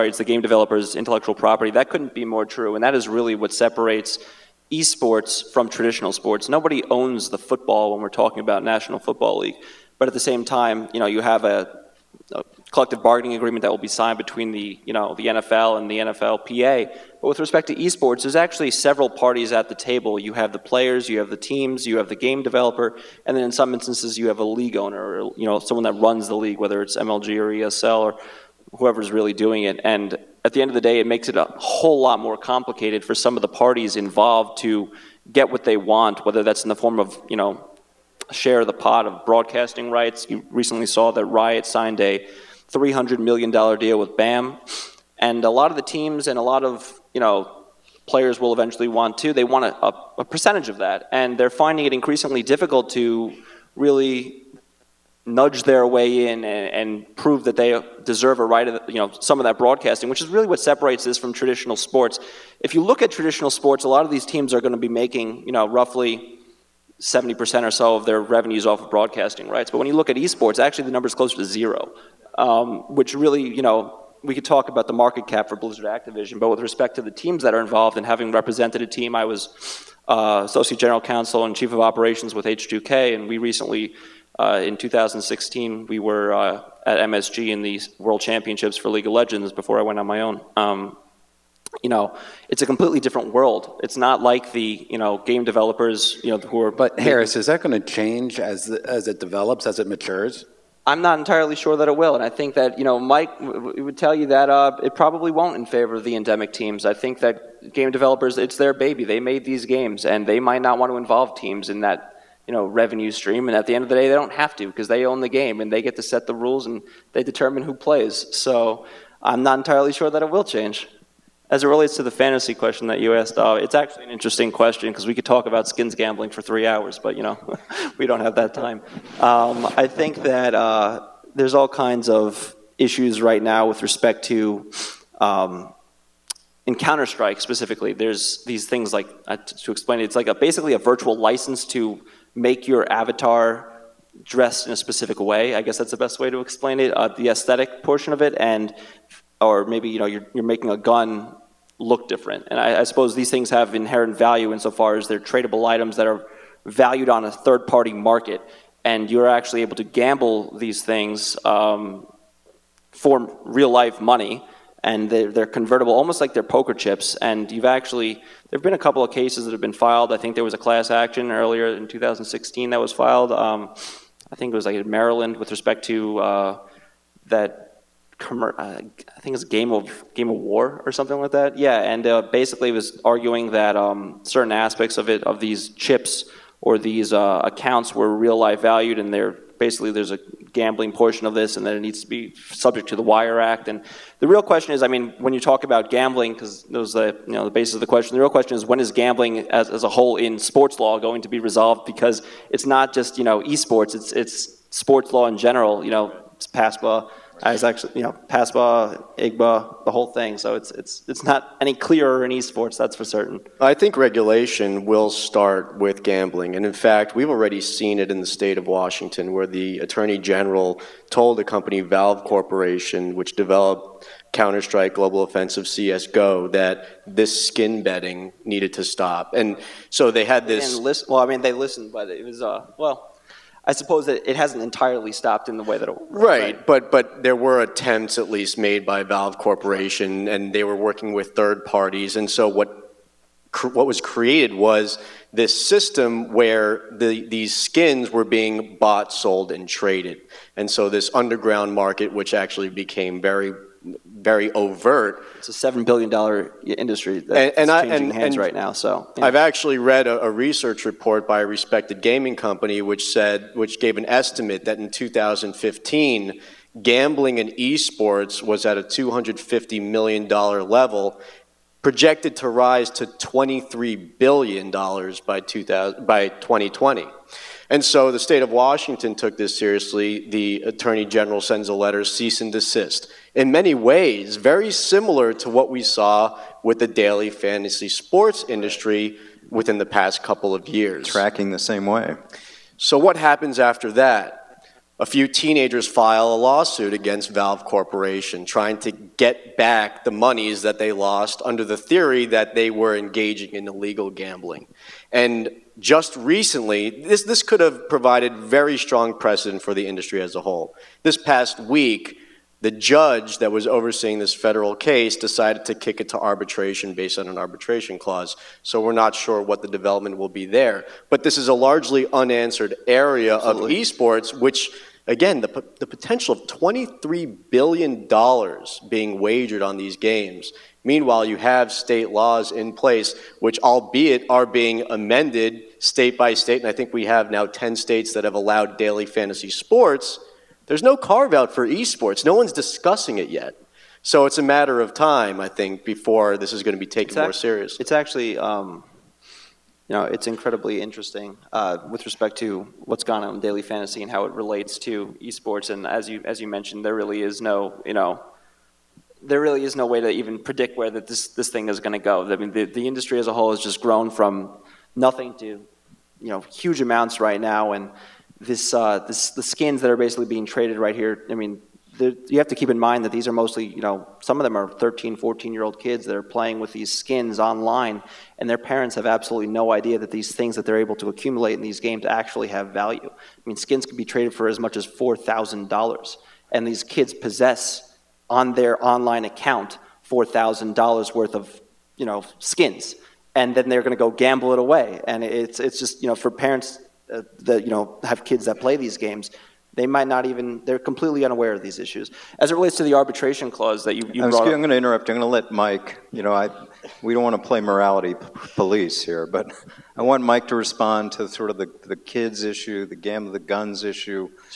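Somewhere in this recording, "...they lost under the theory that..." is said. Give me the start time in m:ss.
5:00.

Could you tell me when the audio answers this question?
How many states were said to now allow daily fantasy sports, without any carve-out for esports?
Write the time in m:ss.
5:37.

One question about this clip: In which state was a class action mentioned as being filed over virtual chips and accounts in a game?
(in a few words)
Maryland.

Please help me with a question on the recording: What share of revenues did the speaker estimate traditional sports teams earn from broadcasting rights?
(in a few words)
70%.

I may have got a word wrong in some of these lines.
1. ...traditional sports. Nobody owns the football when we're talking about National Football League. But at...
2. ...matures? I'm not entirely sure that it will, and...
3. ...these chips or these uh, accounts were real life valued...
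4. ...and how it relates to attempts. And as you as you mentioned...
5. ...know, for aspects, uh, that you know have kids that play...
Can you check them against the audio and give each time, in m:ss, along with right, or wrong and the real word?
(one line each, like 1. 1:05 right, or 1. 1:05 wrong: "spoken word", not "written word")
1. 0:05 right
2. 1:39 right
3. 3:05 right
4. 5:54 wrong: "esports", not "attempts"
5. 6:36 wrong: "parents", not "aspects".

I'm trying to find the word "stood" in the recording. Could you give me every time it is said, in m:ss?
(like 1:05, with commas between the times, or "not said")
not said.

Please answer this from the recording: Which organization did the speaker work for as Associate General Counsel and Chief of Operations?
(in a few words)
H2K.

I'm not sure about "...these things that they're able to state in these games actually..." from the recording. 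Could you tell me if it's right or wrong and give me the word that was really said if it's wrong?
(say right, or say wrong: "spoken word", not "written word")
wrong: "accumulate", not "state".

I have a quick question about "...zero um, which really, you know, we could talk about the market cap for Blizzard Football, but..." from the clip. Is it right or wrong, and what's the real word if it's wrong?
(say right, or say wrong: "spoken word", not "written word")
wrong: "Activision", not "Football".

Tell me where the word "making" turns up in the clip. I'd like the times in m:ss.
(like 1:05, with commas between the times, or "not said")
1:04, 2:30.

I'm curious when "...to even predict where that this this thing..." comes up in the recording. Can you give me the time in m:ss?
6:00.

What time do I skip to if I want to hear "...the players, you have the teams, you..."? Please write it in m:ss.
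0:20.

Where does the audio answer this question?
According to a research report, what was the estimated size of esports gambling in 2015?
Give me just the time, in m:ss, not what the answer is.
4:28.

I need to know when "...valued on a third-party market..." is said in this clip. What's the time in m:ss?
2:36.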